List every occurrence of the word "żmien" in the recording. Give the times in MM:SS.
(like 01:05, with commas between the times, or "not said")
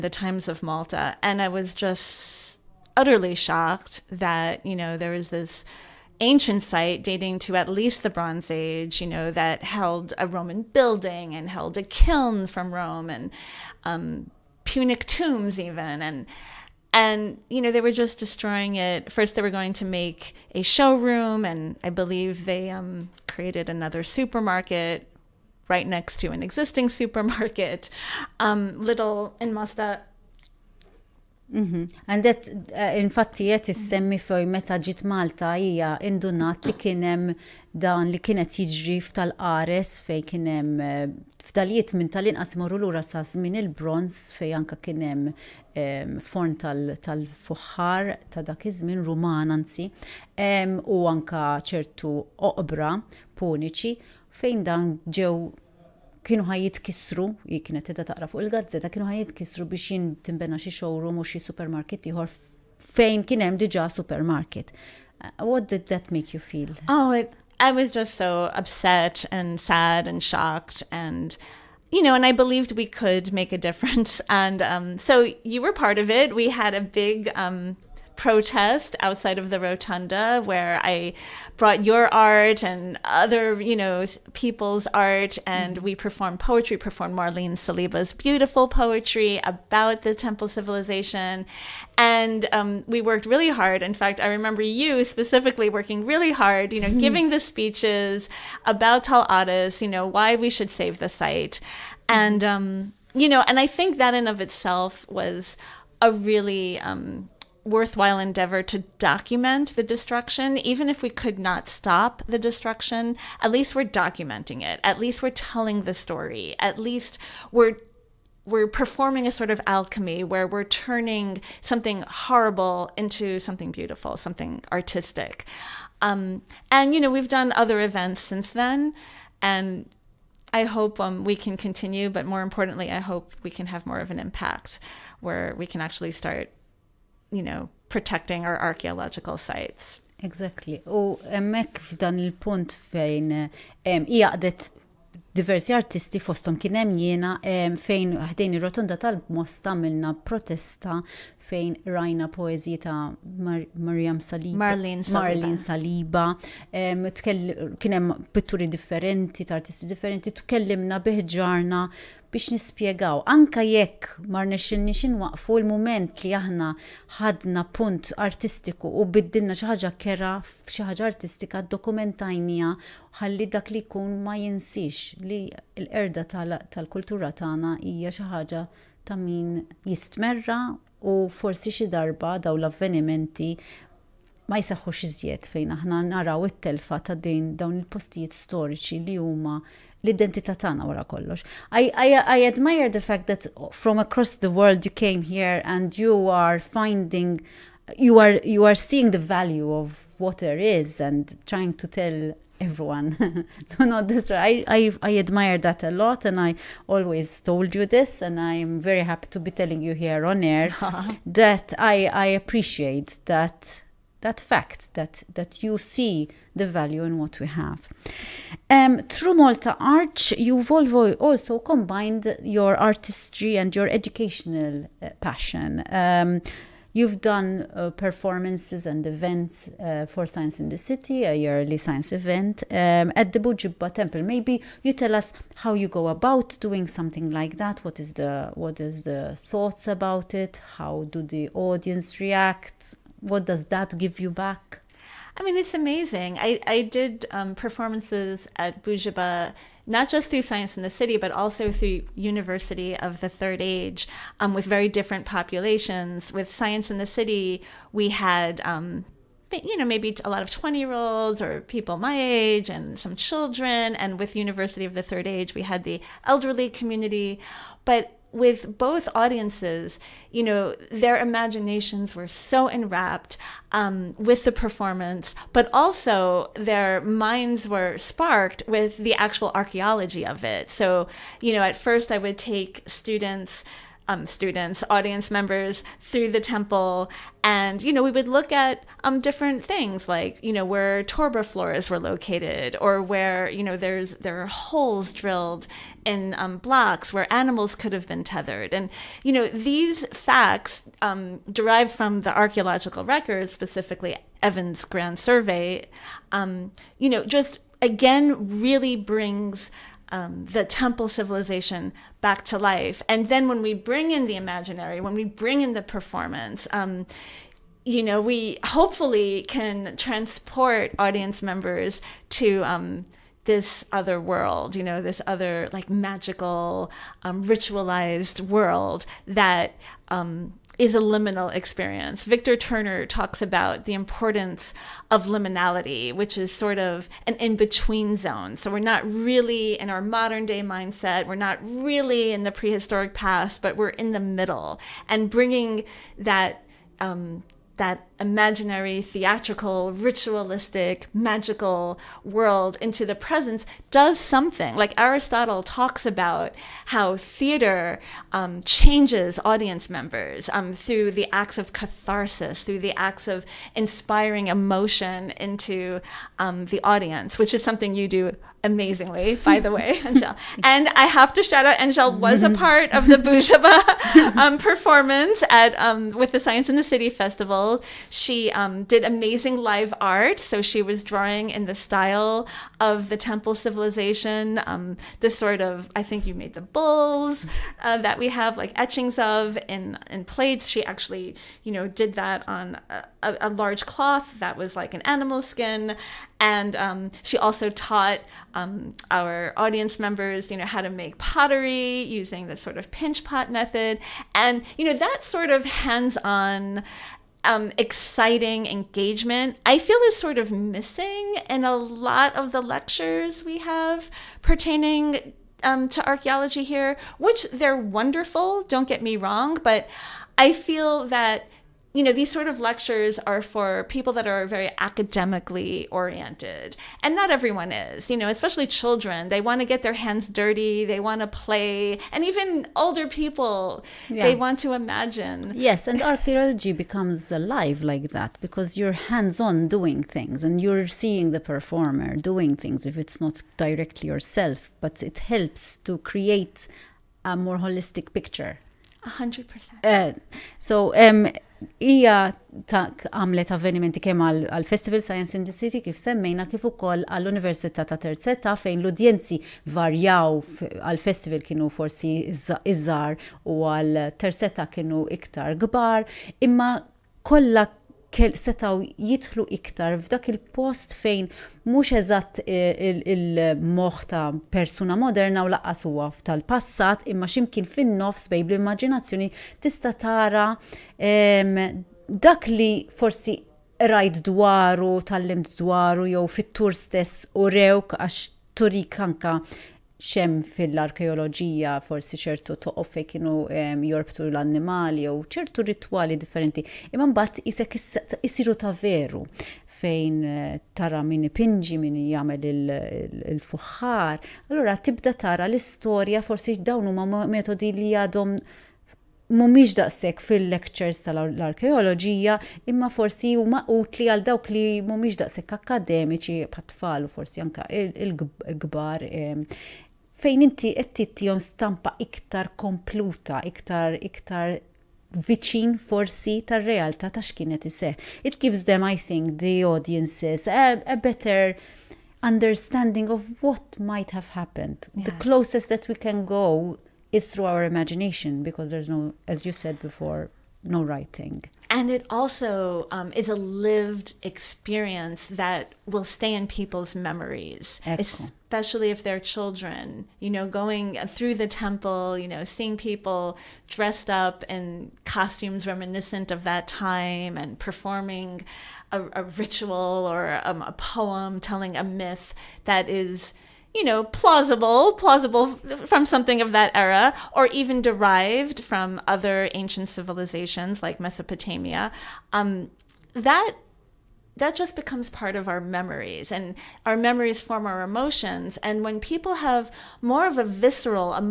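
00:43, 00:48.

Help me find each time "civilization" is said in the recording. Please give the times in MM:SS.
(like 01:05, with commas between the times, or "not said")
01:30, 05:11, 06:23, 09:29.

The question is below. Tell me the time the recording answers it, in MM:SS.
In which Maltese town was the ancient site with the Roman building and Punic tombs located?
00:29.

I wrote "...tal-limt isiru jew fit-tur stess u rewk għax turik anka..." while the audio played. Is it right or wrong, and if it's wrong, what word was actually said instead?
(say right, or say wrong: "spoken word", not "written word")
wrong: "dwaru", not "isiru".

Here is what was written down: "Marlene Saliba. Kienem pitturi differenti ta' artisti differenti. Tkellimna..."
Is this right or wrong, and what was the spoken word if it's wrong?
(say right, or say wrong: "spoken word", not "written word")
right.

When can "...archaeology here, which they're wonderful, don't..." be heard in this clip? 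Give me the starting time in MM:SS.
06:56.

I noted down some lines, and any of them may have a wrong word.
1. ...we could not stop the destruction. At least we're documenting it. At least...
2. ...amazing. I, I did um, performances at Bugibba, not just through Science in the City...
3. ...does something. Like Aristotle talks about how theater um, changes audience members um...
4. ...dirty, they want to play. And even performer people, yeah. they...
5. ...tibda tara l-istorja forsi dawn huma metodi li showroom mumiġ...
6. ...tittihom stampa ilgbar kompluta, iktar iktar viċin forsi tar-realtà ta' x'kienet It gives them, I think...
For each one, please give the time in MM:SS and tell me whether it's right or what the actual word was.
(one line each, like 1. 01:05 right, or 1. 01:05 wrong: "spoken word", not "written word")
1. 01:51 right
2. 04:05 right
3. 05:53 right
4. 07:10 wrong: "older", not "performer"
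5. 08:24 wrong: "jadom", not "showroom"
6. 08:40 wrong: "iktar", not "ilgbar".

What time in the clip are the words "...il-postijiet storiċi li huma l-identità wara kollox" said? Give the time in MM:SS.
03:07.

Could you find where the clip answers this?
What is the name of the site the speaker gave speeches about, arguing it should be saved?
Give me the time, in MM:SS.
01:39.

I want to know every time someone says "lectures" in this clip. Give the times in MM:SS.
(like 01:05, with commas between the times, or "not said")
06:52, 07:02, 08:30.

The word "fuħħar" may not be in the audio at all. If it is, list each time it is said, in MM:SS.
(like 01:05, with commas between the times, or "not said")
00:46, 08:23.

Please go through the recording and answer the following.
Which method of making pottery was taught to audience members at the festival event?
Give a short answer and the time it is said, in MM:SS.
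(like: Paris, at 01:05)
Pinch pot method, at 06:42.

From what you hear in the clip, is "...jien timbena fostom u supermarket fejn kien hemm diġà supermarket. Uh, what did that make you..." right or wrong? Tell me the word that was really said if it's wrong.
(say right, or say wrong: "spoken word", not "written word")
wrong: "showroom", not "fostom".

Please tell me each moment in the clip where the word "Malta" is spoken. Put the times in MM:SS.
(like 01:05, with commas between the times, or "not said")
00:00, 00:35, 03:39.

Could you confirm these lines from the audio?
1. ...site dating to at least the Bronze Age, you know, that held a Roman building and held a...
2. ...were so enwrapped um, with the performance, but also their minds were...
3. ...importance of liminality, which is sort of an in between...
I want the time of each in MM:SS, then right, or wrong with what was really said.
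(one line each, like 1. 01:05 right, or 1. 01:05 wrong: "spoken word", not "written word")
1. 00:06 right
2. 04:32 right
3. 05:33 right.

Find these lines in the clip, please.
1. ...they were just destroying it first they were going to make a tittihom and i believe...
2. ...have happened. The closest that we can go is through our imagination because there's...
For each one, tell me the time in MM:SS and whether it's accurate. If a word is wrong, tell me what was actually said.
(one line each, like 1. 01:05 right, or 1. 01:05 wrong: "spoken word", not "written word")
1. 00:17 wrong: "showroom", not "tittihom"
2. 08:54 right.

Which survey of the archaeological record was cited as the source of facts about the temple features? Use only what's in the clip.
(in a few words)
Evans Grand Survey.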